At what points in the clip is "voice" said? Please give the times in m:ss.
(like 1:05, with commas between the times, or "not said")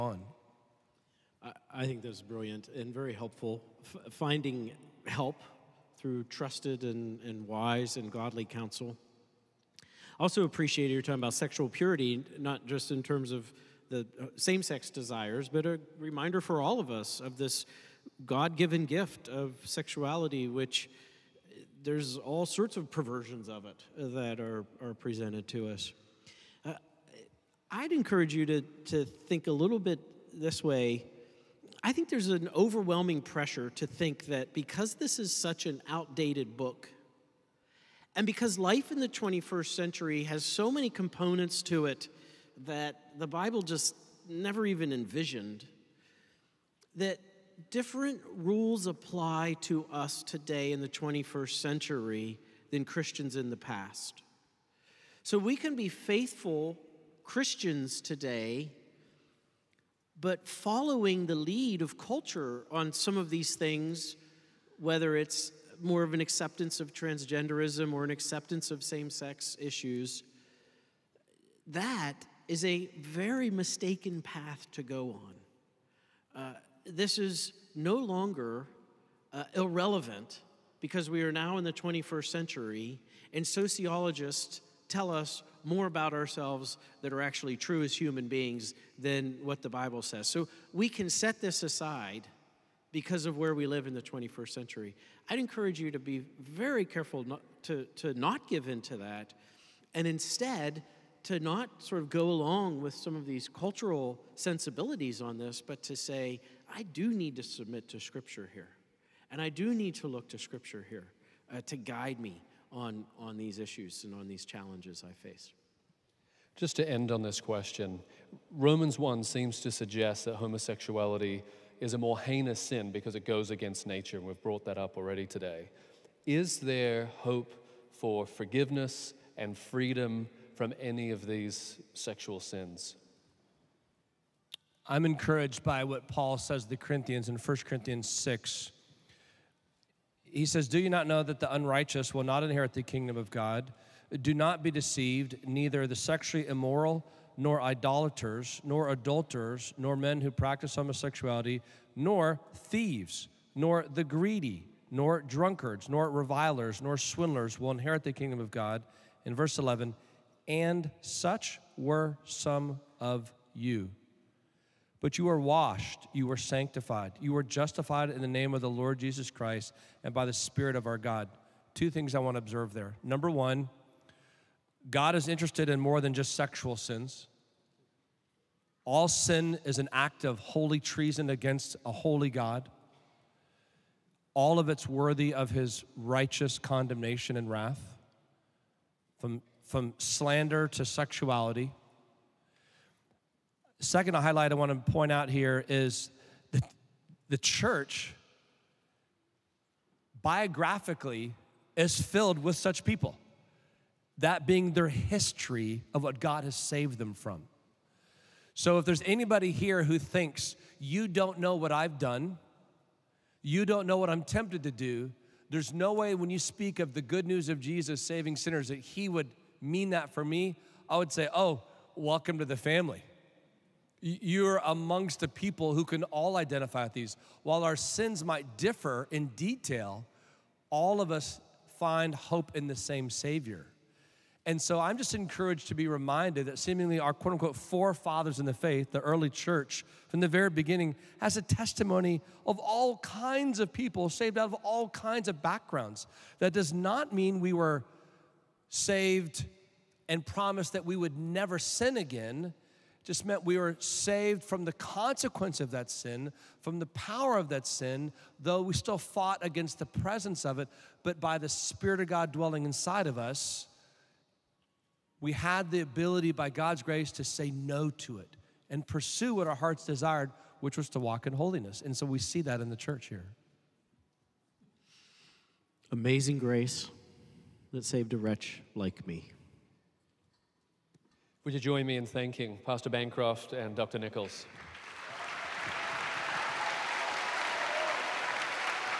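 not said.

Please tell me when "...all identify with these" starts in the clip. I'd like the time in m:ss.
3:46.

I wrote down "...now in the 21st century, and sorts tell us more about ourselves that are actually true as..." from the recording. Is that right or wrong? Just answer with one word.
wrong.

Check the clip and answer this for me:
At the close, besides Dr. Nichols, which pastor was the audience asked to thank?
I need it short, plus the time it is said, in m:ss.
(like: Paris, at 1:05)
Pastor Bancroft, at 4:42.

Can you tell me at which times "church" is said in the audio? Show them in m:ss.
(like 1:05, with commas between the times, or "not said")
3:17, 3:59, 4:32.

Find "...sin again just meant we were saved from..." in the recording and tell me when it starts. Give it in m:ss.
4:11.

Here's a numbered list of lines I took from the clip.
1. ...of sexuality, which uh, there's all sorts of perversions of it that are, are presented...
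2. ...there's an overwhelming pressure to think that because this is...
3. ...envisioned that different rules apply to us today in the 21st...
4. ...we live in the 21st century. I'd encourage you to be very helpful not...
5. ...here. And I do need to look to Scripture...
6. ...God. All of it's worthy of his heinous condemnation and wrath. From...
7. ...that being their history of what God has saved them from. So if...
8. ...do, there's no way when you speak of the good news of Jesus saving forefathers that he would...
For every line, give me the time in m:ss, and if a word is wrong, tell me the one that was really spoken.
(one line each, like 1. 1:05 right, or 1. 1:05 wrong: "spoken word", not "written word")
1. 0:19 right
2. 0:32 right
3. 0:44 right
4. 1:33 wrong: "careful", not "helpful"
5. 1:48 right
6. 3:02 wrong: "righteous", not "heinous"
7. 3:24 right
8. 3:34 wrong: "sinners", not "forefathers".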